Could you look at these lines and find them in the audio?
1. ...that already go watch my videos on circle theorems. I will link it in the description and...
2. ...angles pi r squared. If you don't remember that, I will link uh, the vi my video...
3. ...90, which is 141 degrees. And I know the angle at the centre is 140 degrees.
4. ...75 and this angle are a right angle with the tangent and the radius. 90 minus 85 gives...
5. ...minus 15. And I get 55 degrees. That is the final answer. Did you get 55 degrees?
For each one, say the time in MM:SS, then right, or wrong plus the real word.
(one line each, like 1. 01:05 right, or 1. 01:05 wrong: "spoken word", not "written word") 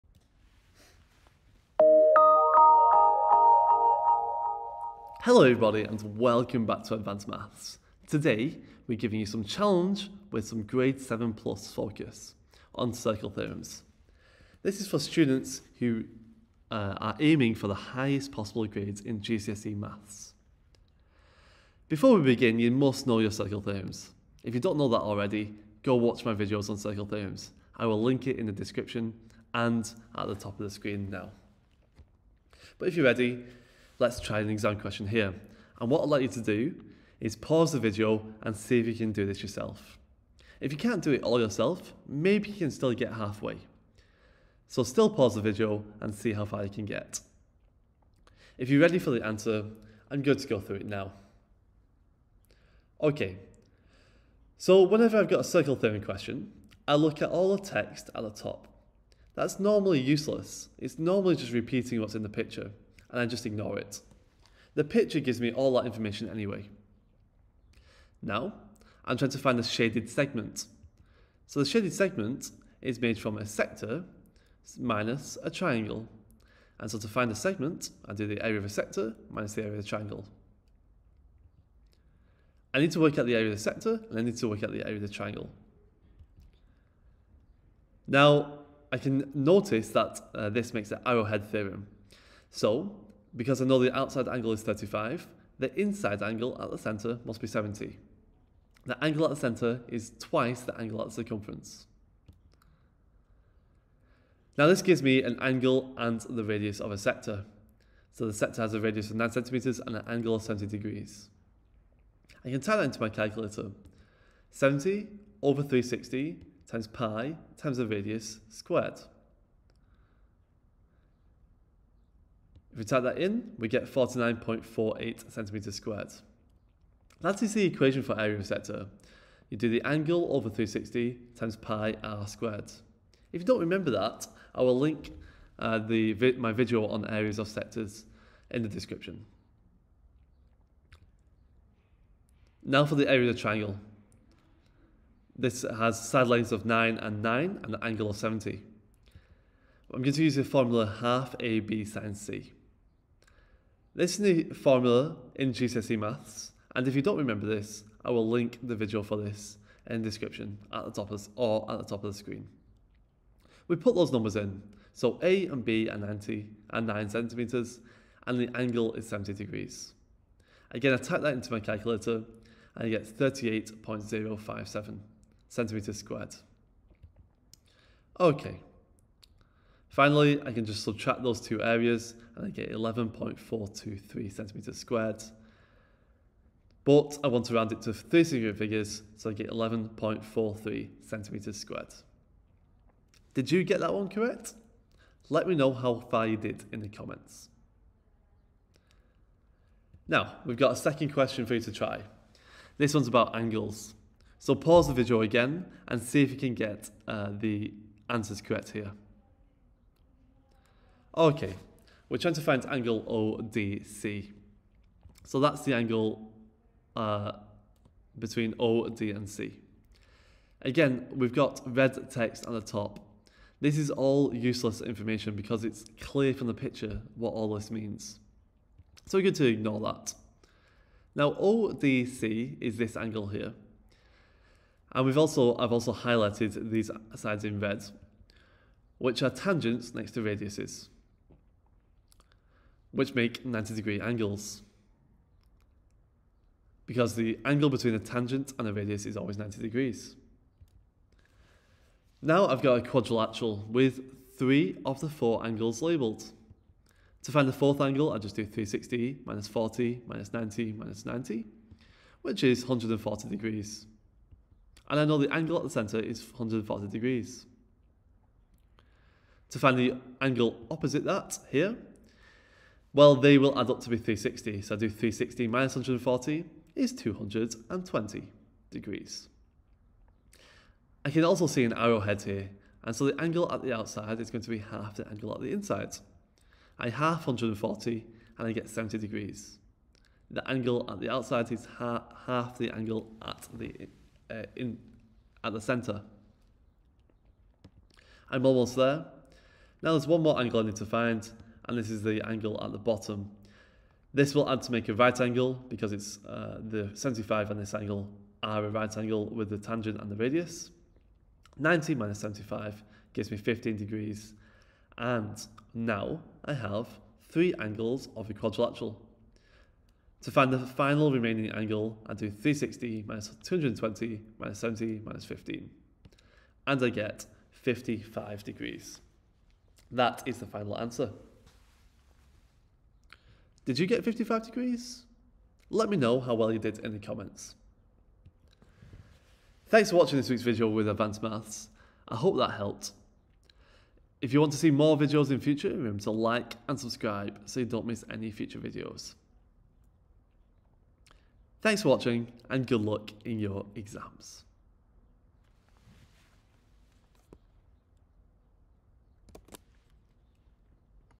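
1. 00:24 right
2. 02:11 wrong: "times", not "angles"
3. 04:21 wrong: "140", not "141"
4. 05:06 wrong: "75", not "85"
5. 05:25 right.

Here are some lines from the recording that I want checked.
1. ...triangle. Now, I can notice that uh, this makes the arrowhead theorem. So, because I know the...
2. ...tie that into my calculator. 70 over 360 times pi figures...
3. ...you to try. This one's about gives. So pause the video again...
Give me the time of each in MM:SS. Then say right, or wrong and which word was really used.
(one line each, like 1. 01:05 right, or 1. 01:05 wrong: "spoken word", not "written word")
1. 01:25 right
2. 01:52 wrong: "times", not "figures"
3. 03:21 wrong: "angles", not "gives".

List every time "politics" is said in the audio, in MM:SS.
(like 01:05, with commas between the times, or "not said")
not said.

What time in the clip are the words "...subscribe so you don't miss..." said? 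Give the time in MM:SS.
05:46.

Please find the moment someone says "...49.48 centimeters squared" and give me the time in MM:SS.
02:03.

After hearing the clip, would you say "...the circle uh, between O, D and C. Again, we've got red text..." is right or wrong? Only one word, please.
wrong.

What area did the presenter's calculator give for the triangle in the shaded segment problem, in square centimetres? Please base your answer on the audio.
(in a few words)
38.057.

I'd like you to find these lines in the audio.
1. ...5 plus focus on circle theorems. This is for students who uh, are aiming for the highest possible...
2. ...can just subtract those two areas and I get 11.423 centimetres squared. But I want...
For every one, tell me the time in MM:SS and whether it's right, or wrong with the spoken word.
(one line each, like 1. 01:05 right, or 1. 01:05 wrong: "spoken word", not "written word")
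1. 00:10 wrong: "7", not "5"
2. 03:00 right.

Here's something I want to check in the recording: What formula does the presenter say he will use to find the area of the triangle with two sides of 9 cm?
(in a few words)
half AB sine C.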